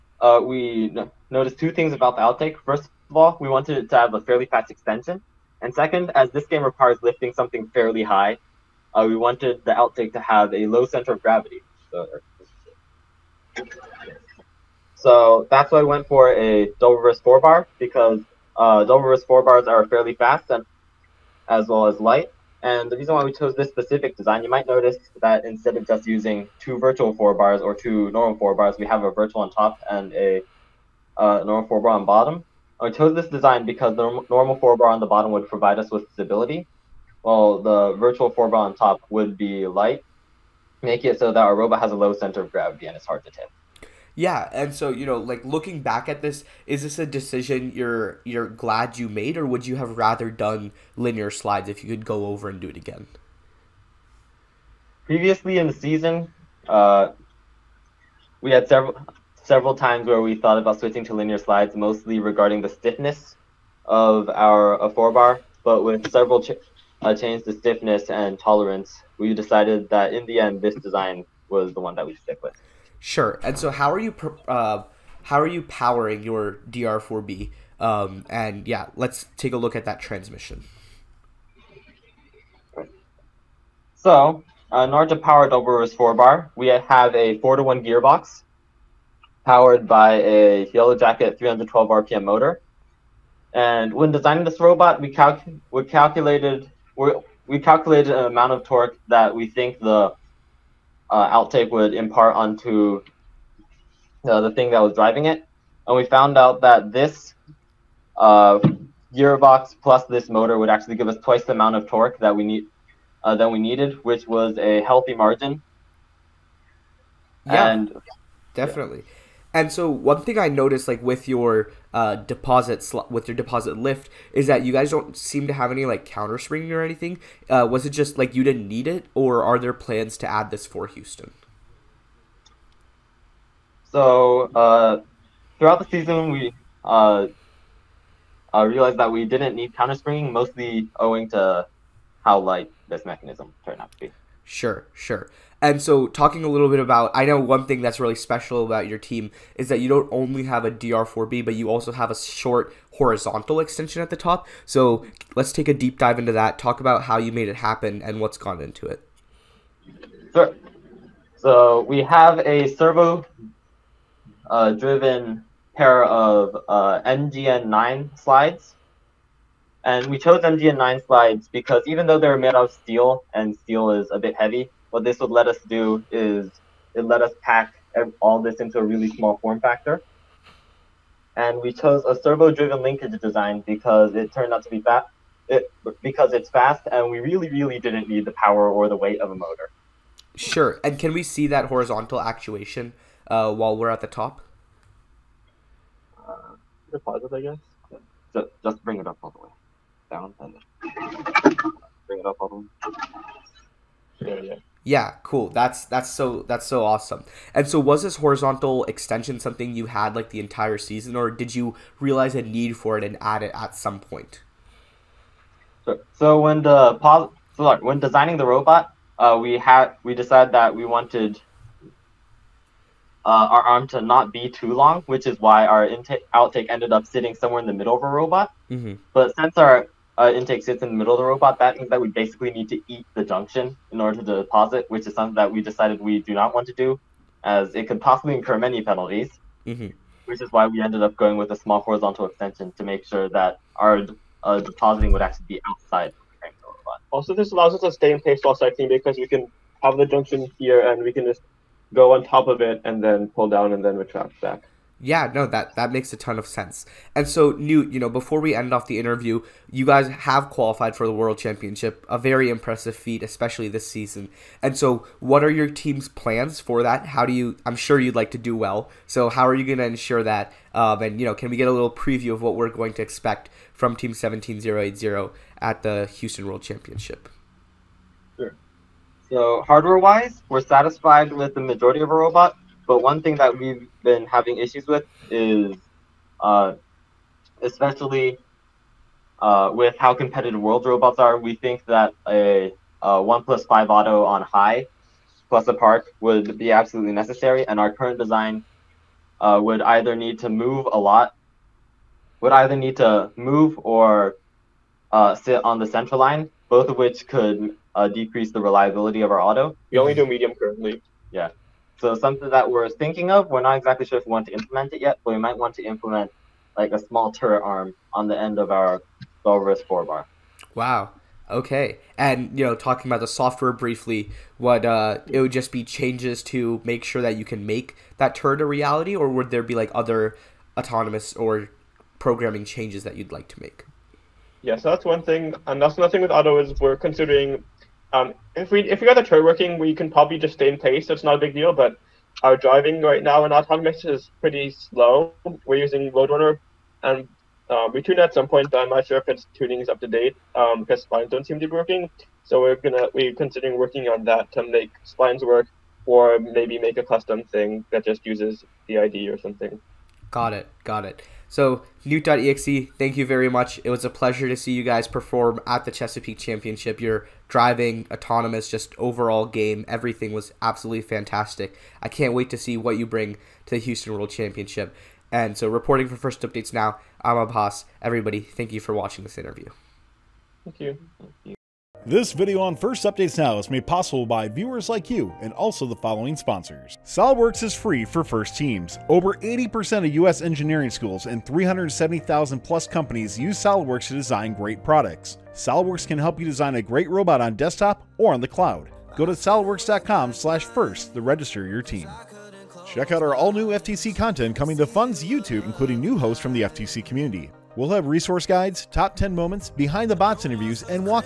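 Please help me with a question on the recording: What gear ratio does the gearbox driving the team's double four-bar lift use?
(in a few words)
4 to 1.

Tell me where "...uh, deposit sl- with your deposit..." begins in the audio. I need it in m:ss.
2:01.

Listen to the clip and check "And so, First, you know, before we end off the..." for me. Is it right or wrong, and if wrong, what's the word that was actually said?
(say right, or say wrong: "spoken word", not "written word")
wrong: "Newt", not "First".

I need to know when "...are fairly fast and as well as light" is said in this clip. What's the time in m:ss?
0:19.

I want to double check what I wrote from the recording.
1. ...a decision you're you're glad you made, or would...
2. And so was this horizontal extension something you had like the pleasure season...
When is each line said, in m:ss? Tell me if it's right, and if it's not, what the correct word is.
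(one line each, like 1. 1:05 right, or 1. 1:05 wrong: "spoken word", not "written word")
1. 0:46 right
2. 3:27 wrong: "entire", not "pleasure".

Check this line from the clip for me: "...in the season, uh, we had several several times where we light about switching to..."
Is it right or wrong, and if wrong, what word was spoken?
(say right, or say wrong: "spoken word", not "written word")
wrong: "thought", not "light".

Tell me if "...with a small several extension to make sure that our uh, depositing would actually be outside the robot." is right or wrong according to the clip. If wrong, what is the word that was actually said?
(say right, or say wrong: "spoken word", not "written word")
wrong: "horizontal", not "several".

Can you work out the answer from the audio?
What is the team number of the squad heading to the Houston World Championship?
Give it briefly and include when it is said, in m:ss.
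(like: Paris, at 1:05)
17080, at 4:34.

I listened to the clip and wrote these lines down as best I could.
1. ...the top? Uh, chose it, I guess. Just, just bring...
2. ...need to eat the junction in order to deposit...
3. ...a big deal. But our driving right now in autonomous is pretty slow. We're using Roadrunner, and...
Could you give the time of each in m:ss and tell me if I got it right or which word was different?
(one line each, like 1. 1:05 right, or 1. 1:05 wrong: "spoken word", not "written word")
1. 3:13 wrong: "pause", not "chose"
2. 3:52 right
3. 5:41 right.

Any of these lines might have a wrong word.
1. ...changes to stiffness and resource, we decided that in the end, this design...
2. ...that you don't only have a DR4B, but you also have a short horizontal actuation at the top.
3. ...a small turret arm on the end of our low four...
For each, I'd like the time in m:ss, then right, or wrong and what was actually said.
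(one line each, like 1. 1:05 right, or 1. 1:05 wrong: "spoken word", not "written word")
1. 1:07 wrong: "tolerance", not "resource"
2. 2:29 wrong: "extension", not "actuation"
3. 5:16 right.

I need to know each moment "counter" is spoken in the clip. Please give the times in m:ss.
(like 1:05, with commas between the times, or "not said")
2:06, 2:19.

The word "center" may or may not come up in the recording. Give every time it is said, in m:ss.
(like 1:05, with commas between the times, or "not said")
0:10, 0:42, 5:05.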